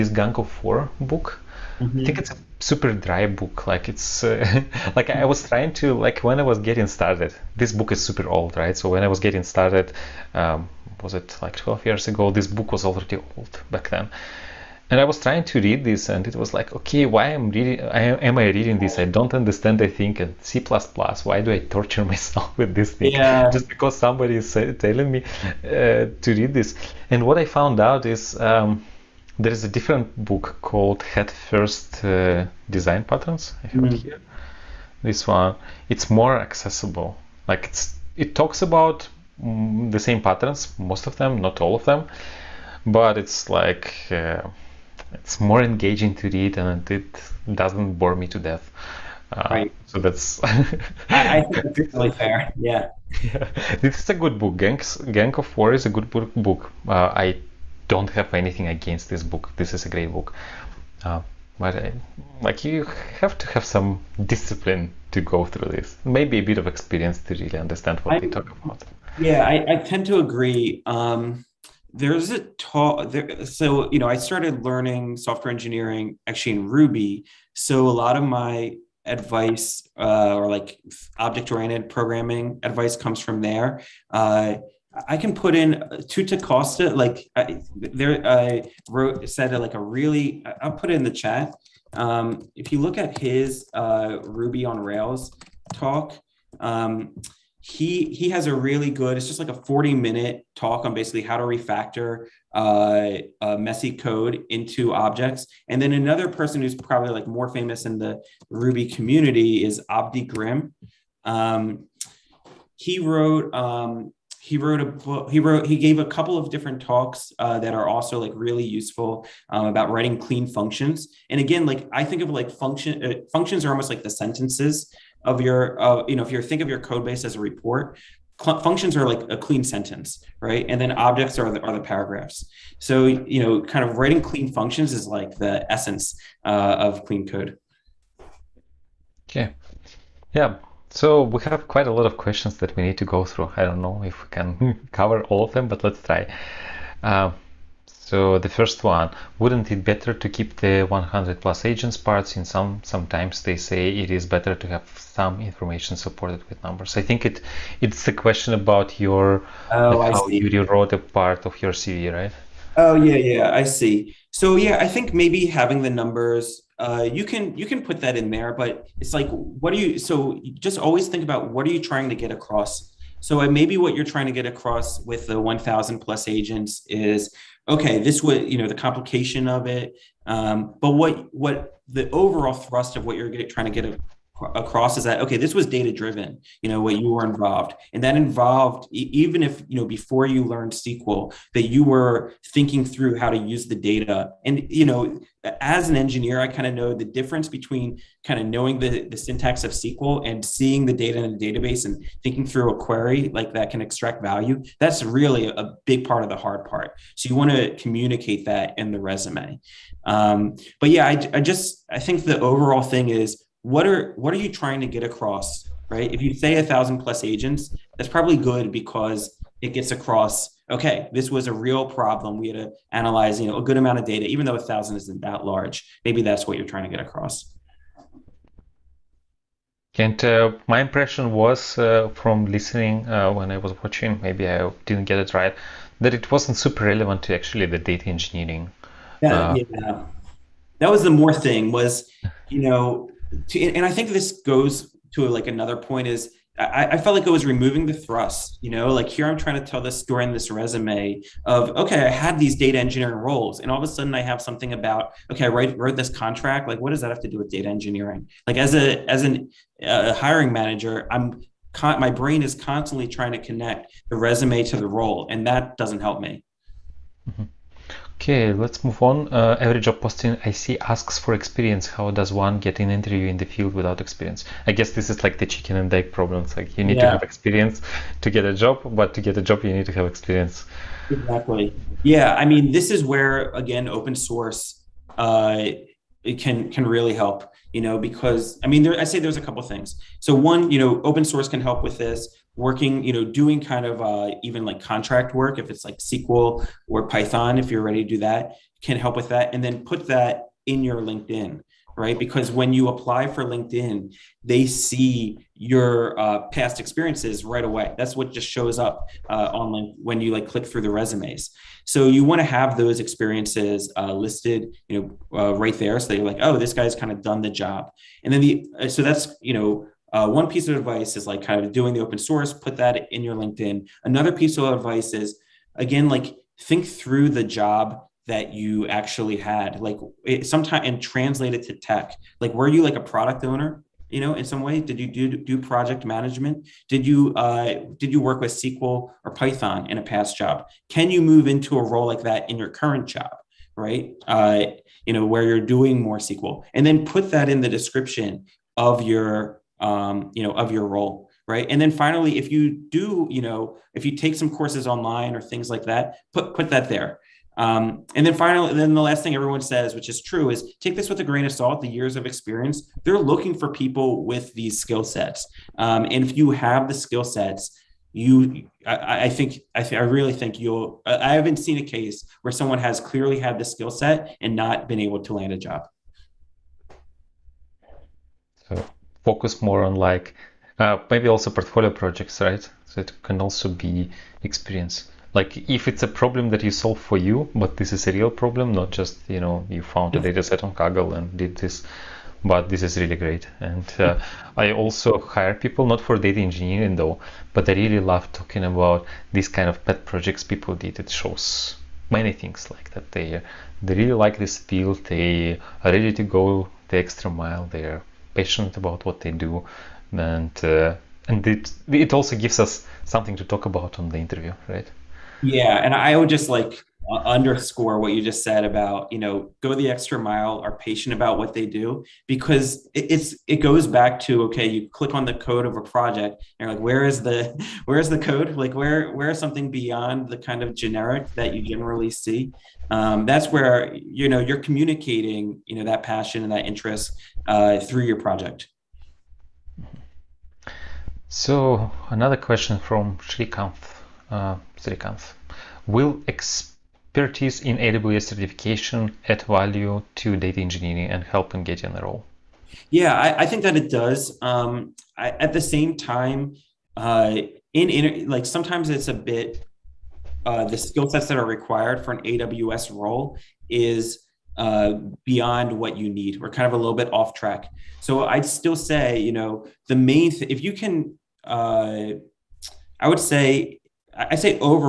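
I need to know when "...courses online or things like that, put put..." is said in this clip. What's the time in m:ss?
5:54.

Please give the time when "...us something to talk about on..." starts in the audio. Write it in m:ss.
6:52.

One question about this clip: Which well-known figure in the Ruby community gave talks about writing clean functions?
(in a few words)
Avdi Grimm.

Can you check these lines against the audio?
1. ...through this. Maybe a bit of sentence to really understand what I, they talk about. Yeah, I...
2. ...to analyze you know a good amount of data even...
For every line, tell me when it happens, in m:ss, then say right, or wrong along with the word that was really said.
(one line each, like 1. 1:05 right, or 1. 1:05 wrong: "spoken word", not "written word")
1. 1:05 wrong: "experience", not "sentence"
2. 3:42 right.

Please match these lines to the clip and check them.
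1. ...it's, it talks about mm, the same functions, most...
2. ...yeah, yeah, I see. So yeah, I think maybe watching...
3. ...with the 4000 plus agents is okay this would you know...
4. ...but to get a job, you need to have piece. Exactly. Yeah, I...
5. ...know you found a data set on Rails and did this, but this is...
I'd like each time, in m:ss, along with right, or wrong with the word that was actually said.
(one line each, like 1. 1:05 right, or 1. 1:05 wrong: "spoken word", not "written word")
1. 0:37 wrong: "patterns", not "functions"
2. 2:42 wrong: "having", not "watching"
3. 2:55 wrong: "1000", not "4000"
4. 4:38 wrong: "experience", not "piece"
5. 6:29 wrong: "Kaggle", not "Rails".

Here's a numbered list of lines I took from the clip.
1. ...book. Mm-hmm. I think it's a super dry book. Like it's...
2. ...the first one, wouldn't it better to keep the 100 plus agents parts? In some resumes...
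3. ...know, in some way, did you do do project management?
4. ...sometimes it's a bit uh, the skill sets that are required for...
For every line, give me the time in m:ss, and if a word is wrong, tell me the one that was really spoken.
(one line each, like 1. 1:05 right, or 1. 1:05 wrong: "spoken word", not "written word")
1. 0:01 right
2. 2:28 wrong: "sometimes", not "resumes"
3. 5:34 right
4. 7:38 right.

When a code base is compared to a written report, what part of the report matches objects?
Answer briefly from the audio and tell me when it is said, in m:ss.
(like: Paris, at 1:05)
paragraphs, at 2:11.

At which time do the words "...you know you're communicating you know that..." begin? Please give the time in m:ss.
7:13.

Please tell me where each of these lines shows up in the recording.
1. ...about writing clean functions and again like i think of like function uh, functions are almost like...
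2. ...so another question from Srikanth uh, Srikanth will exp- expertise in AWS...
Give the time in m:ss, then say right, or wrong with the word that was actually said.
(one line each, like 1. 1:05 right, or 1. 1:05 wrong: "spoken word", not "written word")
1. 1:59 right
2. 7:21 right.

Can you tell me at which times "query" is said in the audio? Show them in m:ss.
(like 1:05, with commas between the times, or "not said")
3:22.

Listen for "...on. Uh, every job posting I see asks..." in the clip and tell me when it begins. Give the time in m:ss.
4:29.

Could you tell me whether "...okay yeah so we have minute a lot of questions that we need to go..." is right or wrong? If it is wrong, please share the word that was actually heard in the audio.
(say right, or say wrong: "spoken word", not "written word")
wrong: "quite", not "minute".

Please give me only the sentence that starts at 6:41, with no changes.
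It shows many things like that.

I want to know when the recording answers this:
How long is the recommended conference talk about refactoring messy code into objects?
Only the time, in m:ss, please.
1:39.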